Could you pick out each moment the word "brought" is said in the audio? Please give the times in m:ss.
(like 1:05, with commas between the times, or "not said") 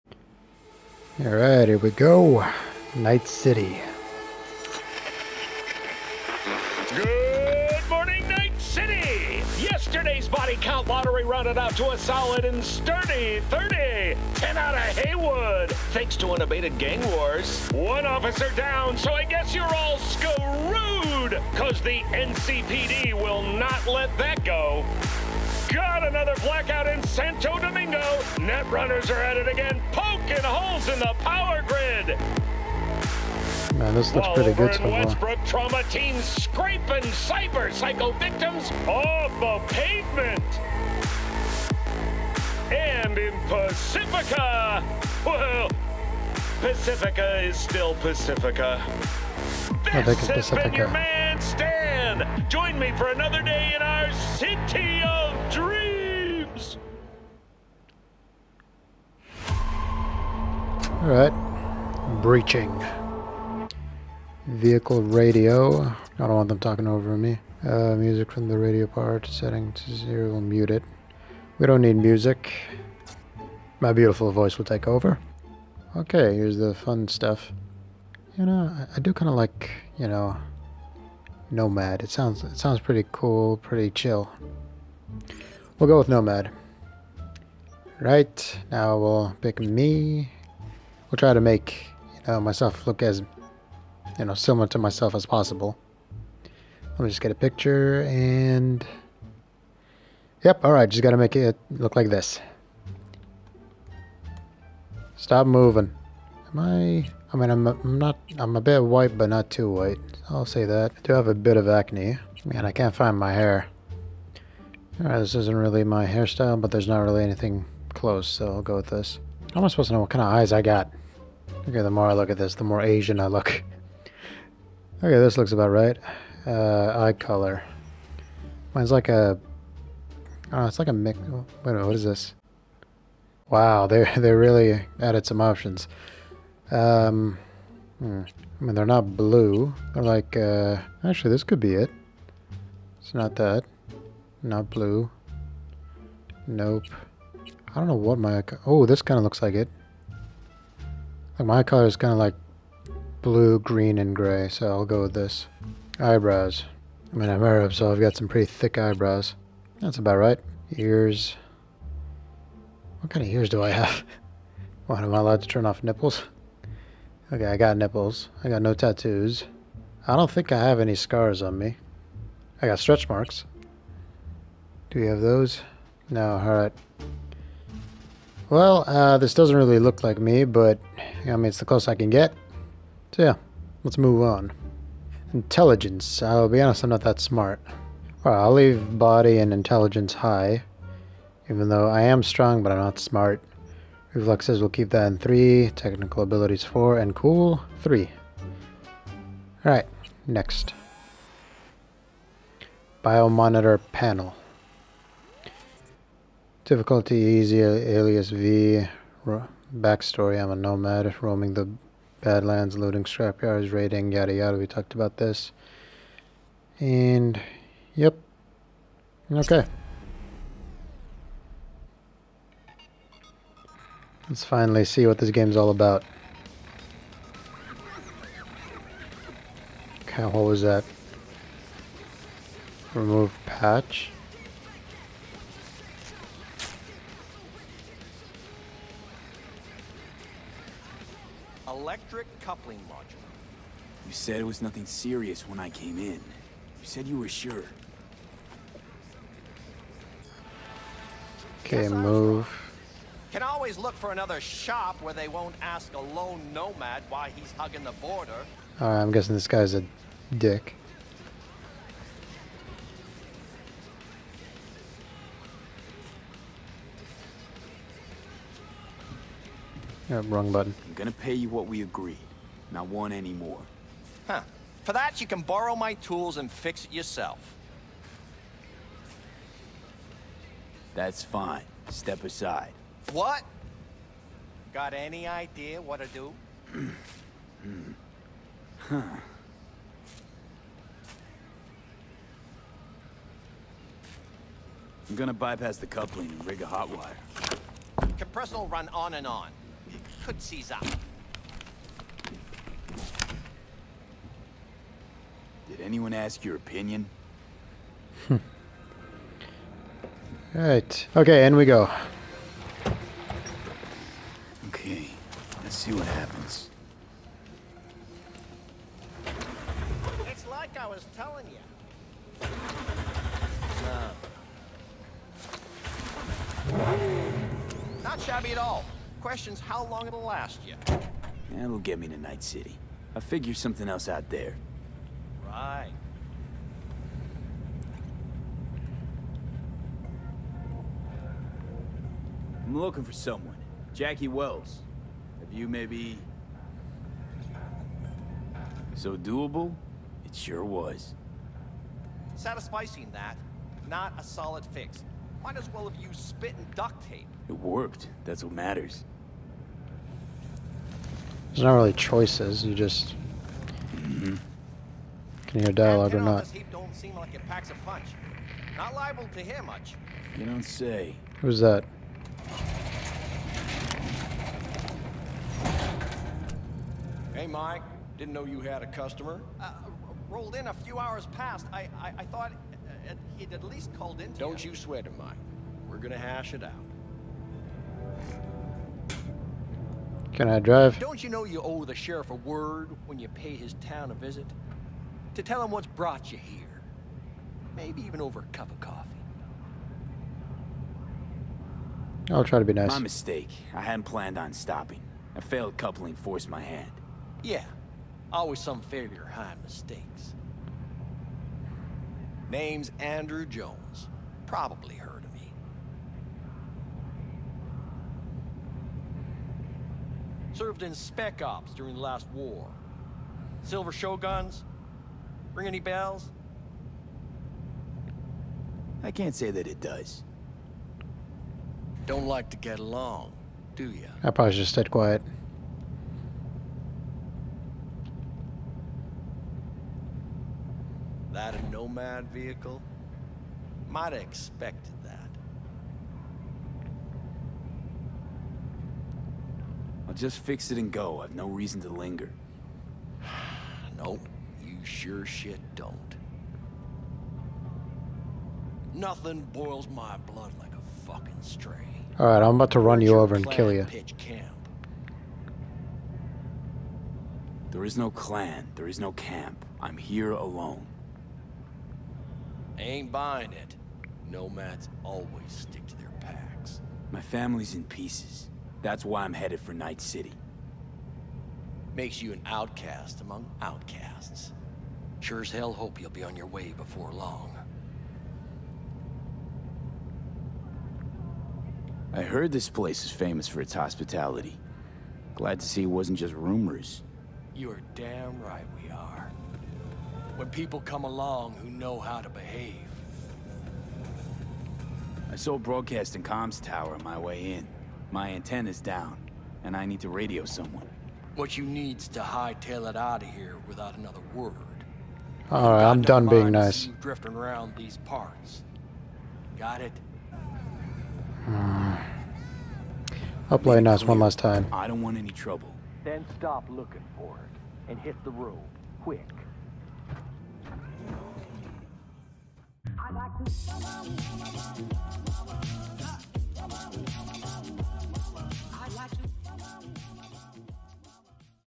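6:35.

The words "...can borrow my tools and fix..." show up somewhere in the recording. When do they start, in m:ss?
4:35.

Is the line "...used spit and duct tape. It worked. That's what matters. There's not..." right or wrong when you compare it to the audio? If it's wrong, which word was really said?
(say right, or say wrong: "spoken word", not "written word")
right.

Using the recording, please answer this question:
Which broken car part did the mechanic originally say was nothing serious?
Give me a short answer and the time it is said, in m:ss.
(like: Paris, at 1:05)
Electric coupling module, at 4:01.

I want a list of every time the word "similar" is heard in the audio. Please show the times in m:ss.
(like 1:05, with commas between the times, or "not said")
1:34.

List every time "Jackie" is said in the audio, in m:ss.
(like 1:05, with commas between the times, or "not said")
5:43.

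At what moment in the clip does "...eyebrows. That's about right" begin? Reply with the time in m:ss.
2:38.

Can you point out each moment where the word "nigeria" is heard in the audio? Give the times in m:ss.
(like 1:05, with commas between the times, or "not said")
not said.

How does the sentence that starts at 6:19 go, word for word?
Uh, rolled in a few hours past.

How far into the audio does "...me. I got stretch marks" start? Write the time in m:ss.
2:51.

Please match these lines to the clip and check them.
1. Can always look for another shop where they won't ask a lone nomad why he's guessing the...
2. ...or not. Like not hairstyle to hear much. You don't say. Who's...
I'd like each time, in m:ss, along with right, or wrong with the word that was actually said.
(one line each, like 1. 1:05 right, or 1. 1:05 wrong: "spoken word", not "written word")
1. 4:13 wrong: "hugging", not "guessing"
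2. 6:06 wrong: "liable", not "hairstyle".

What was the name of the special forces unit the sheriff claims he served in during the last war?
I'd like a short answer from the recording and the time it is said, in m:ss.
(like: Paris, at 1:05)
Silver Shoguns, at 7:03.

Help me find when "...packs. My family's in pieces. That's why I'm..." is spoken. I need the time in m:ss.
7:56.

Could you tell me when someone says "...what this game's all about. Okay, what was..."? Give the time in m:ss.
3:45.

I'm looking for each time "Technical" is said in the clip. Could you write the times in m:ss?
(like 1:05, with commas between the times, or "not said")
3:15.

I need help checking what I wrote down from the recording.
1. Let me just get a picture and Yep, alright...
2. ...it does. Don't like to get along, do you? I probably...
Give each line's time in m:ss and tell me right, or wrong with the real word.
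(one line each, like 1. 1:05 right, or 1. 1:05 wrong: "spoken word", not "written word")
1. 1:36 right
2. 7:09 right.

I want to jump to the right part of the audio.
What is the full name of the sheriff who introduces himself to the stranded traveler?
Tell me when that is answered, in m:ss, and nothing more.
6:52.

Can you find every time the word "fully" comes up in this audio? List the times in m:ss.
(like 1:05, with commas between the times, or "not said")
not said.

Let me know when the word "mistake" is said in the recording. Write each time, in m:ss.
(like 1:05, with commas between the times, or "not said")
6:42, 6:49.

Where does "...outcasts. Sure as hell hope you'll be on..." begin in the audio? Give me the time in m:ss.
8:03.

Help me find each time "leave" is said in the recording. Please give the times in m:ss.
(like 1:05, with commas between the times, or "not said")
3:08.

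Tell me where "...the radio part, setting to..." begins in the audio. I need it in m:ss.
1:08.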